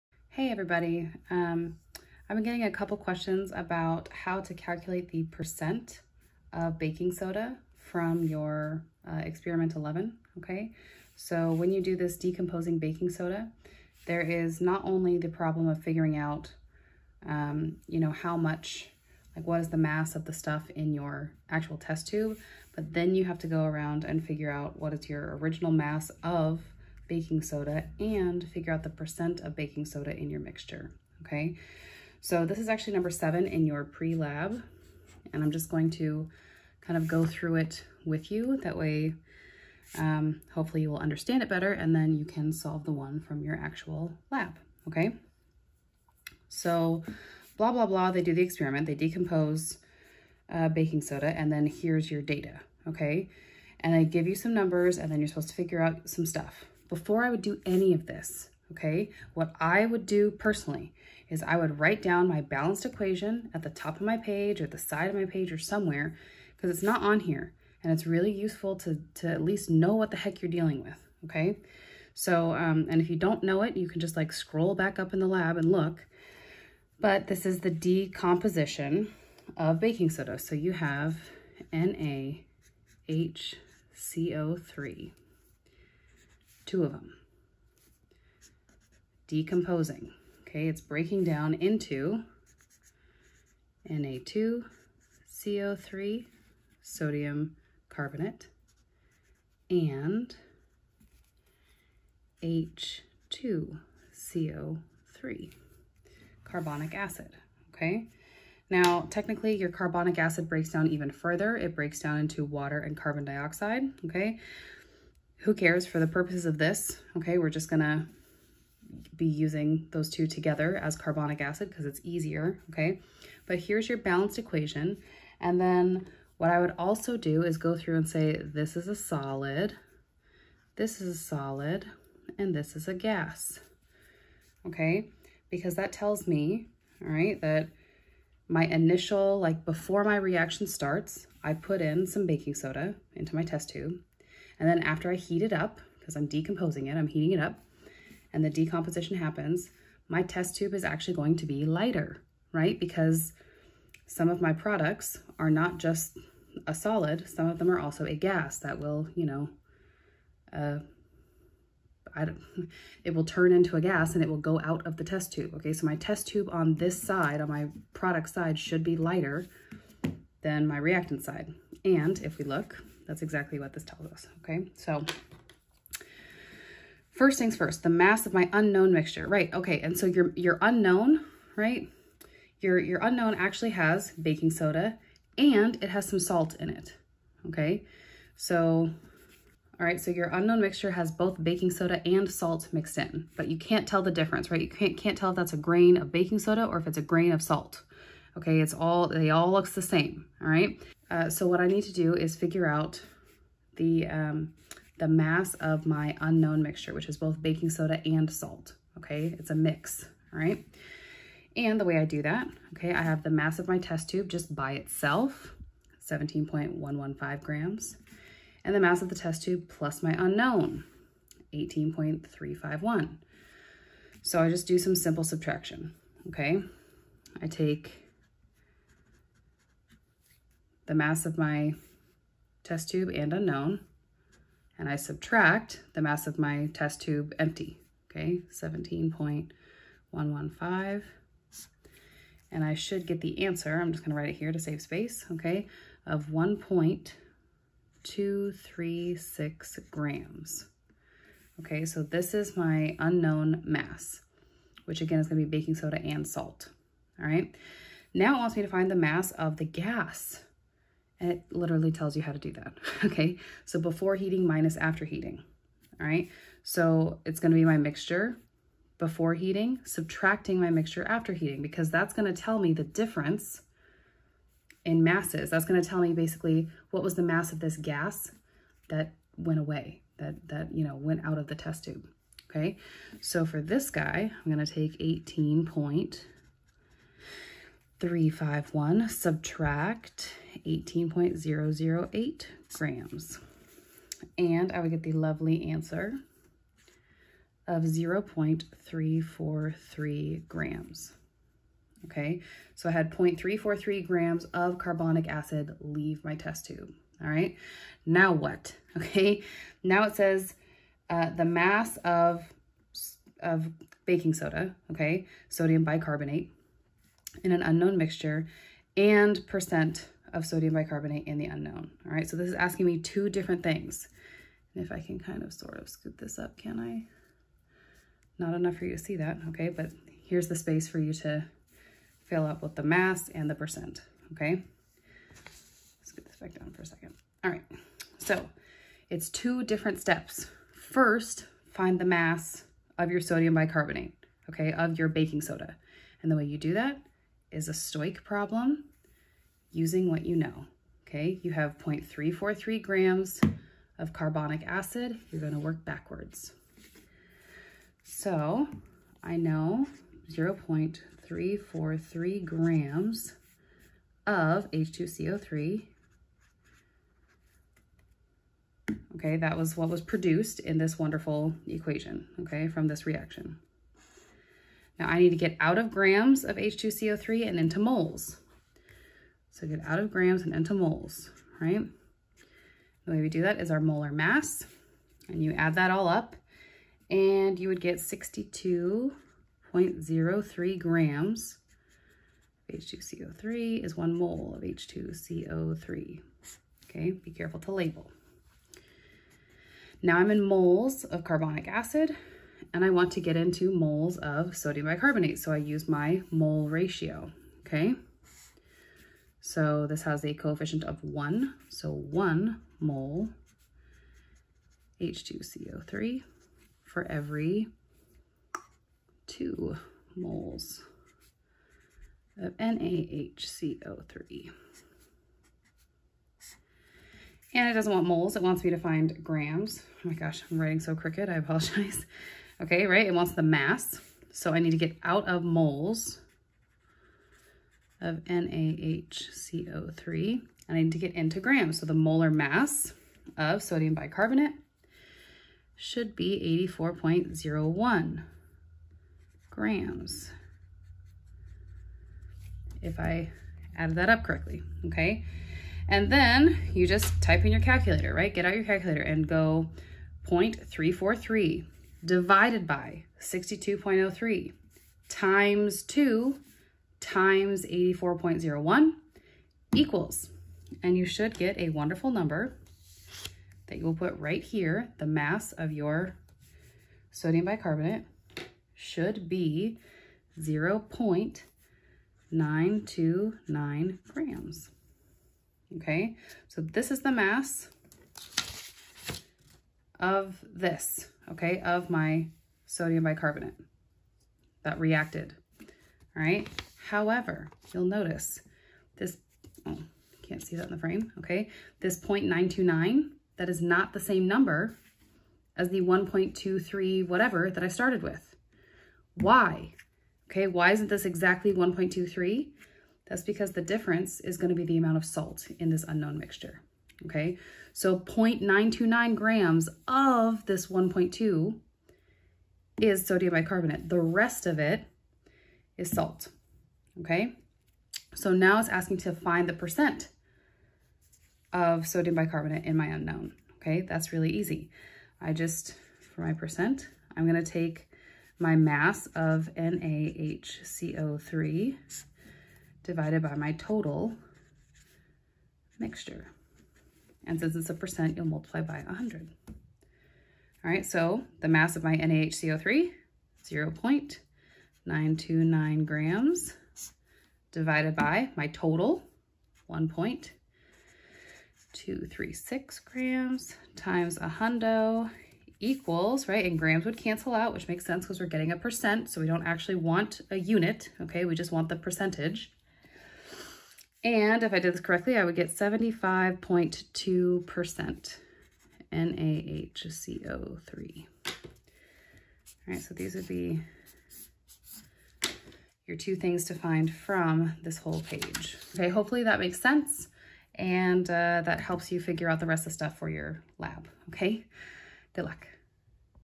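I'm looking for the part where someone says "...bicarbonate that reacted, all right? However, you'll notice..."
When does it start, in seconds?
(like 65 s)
493 s.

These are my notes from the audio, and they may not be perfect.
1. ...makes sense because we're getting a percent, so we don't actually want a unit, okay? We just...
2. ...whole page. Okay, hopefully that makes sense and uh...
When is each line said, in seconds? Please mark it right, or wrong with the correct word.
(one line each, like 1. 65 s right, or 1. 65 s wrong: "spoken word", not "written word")
1. 567 s right
2. 587 s right.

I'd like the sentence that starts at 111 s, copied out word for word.
It breaks down into water and carbon dioxide, okay?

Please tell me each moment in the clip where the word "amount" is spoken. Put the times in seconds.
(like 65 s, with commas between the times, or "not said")
514 s.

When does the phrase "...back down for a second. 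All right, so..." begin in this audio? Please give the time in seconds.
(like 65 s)
336 s.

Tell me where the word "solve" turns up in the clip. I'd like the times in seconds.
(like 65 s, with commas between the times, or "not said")
42 s.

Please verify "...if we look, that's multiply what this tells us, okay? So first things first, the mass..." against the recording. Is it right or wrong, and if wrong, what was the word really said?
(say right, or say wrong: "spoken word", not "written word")
wrong: "exactly", not "multiply".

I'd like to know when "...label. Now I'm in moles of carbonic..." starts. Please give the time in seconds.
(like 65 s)
397 s.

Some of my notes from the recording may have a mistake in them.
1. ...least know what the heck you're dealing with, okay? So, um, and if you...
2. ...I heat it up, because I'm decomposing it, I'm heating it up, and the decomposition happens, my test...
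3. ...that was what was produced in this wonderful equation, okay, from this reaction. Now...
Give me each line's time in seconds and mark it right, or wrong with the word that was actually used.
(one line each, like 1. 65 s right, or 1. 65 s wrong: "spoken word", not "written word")
1. 69 s right
2. 145 s right
3. 369 s right.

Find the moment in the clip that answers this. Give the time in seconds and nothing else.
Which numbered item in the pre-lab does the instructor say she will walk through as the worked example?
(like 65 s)
32 s.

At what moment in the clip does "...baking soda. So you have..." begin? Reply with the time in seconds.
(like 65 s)
79 s.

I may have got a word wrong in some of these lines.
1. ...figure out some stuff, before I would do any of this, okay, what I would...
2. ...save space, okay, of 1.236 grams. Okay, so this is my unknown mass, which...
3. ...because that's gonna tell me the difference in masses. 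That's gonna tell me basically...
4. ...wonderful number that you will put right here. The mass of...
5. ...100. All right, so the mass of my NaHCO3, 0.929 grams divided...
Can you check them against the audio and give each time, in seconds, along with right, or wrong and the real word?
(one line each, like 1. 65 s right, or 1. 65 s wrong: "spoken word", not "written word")
1. 55 s right
2. 244 s right
3. 271 s right
4. 471 s right
5. 548 s right.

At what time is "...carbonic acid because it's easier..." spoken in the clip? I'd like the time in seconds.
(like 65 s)
120 s.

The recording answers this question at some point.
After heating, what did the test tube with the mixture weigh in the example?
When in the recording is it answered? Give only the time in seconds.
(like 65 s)
290 s.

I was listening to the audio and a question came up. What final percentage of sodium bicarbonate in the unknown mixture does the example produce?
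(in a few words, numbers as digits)
75.2%.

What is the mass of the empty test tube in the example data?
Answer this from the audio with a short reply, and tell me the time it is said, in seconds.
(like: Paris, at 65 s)
17.115 grams, at 216 s.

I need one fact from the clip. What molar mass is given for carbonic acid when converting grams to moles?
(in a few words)
62.03 grams.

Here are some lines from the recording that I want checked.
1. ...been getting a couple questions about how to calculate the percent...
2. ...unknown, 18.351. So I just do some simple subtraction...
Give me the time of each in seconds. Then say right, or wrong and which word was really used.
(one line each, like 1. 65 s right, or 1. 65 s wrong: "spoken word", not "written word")
1. 2 s right
2. 220 s right.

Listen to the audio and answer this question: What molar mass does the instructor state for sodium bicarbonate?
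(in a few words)
84.01 grams.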